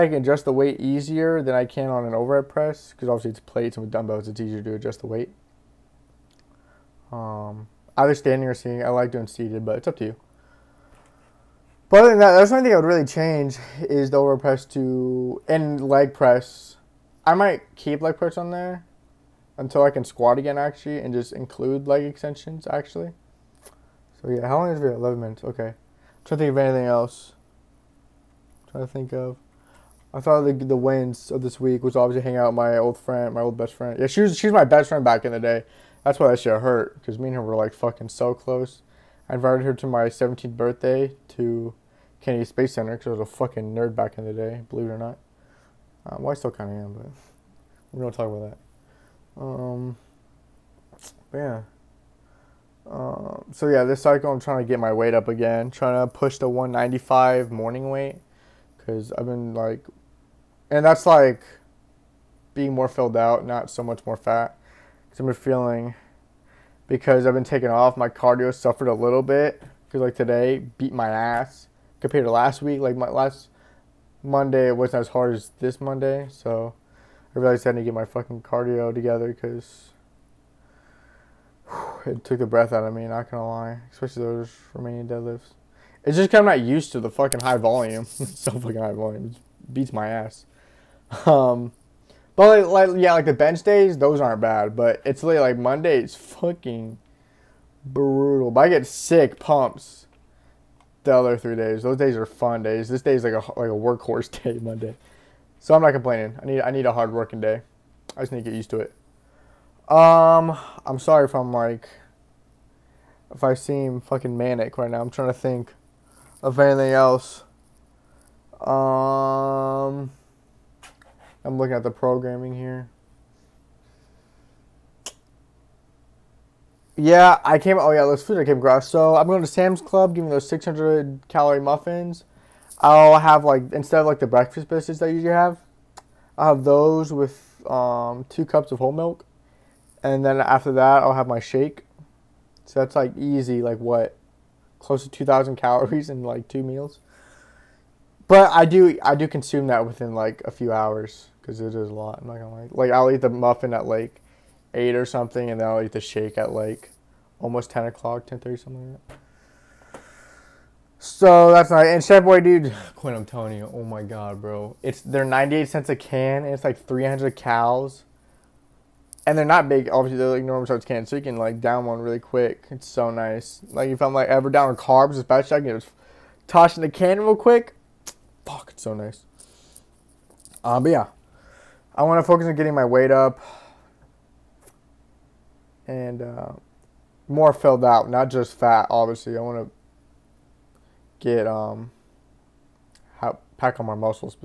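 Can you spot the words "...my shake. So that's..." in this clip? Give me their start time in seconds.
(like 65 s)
141 s.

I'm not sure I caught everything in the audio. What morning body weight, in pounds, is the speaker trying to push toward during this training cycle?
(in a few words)
195.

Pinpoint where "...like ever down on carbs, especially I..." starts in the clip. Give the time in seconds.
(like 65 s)
174 s.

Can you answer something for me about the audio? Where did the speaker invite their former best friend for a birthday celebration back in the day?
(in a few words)
Kennedy Space Center.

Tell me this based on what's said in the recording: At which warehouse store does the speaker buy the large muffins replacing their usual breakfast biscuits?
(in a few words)
Sam's Club.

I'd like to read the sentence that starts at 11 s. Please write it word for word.
But other than that, that's only thing I would really change is the overhead press to and leg press.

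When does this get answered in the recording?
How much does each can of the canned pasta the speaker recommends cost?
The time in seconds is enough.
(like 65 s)
165 s.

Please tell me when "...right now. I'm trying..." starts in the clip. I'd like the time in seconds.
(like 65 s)
114 s.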